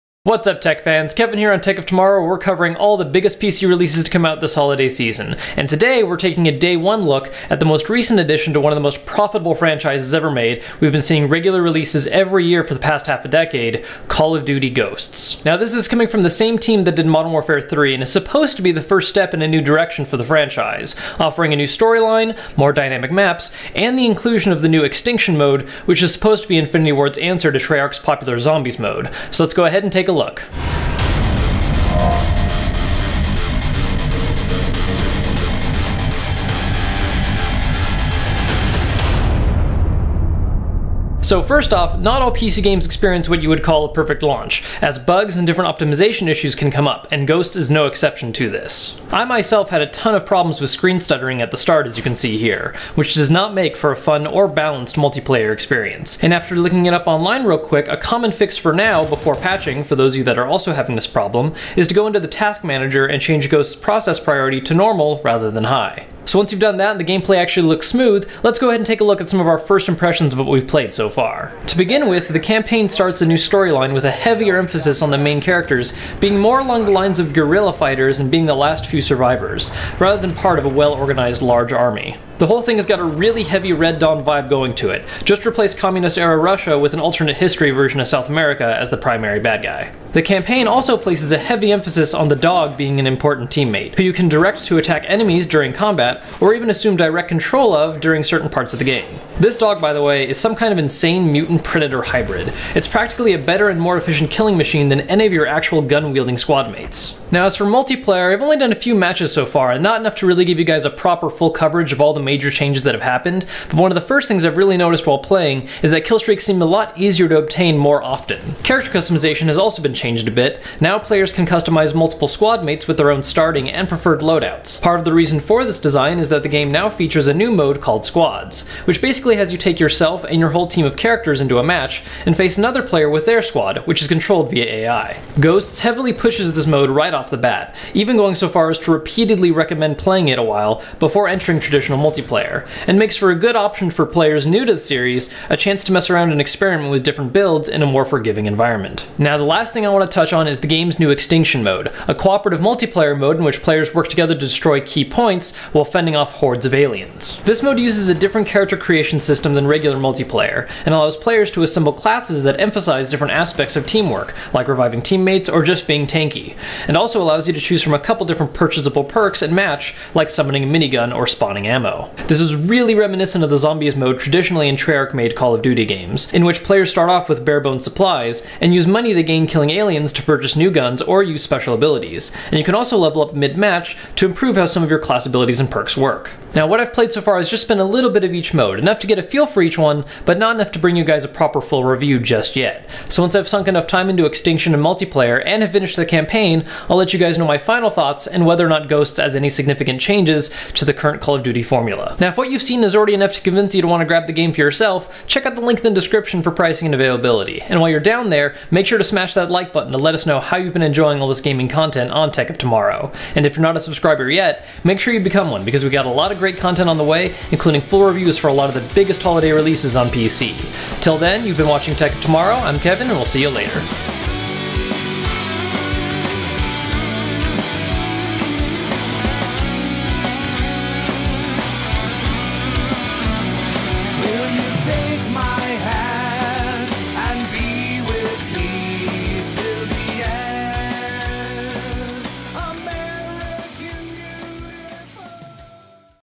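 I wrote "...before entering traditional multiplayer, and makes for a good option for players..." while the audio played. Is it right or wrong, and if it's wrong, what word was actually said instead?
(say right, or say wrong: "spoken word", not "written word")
right.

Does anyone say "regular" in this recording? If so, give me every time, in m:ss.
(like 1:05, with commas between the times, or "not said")
0:11, 2:39.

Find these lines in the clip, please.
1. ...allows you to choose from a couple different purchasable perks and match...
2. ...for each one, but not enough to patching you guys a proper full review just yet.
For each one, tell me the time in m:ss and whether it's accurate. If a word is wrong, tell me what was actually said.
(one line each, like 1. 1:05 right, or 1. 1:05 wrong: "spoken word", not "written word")
1. 2:47 right
2. 3:09 wrong: "bring", not "patching".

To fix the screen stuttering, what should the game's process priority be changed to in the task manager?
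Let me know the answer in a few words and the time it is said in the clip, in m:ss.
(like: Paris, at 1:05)
normal, at 1:04.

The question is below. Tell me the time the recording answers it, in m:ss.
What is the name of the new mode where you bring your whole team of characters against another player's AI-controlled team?
2:08.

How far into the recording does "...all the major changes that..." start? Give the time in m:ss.
1:52.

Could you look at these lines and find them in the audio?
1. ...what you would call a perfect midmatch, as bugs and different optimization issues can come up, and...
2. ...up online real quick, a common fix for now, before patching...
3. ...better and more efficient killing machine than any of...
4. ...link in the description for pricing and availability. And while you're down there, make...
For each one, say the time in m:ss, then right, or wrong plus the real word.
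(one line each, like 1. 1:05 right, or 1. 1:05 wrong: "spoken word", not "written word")
1. 0:43 wrong: "launch", not "midmatch"
2. 0:56 right
3. 1:43 right
4. 3:25 right.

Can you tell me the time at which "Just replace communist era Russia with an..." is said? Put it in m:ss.
1:25.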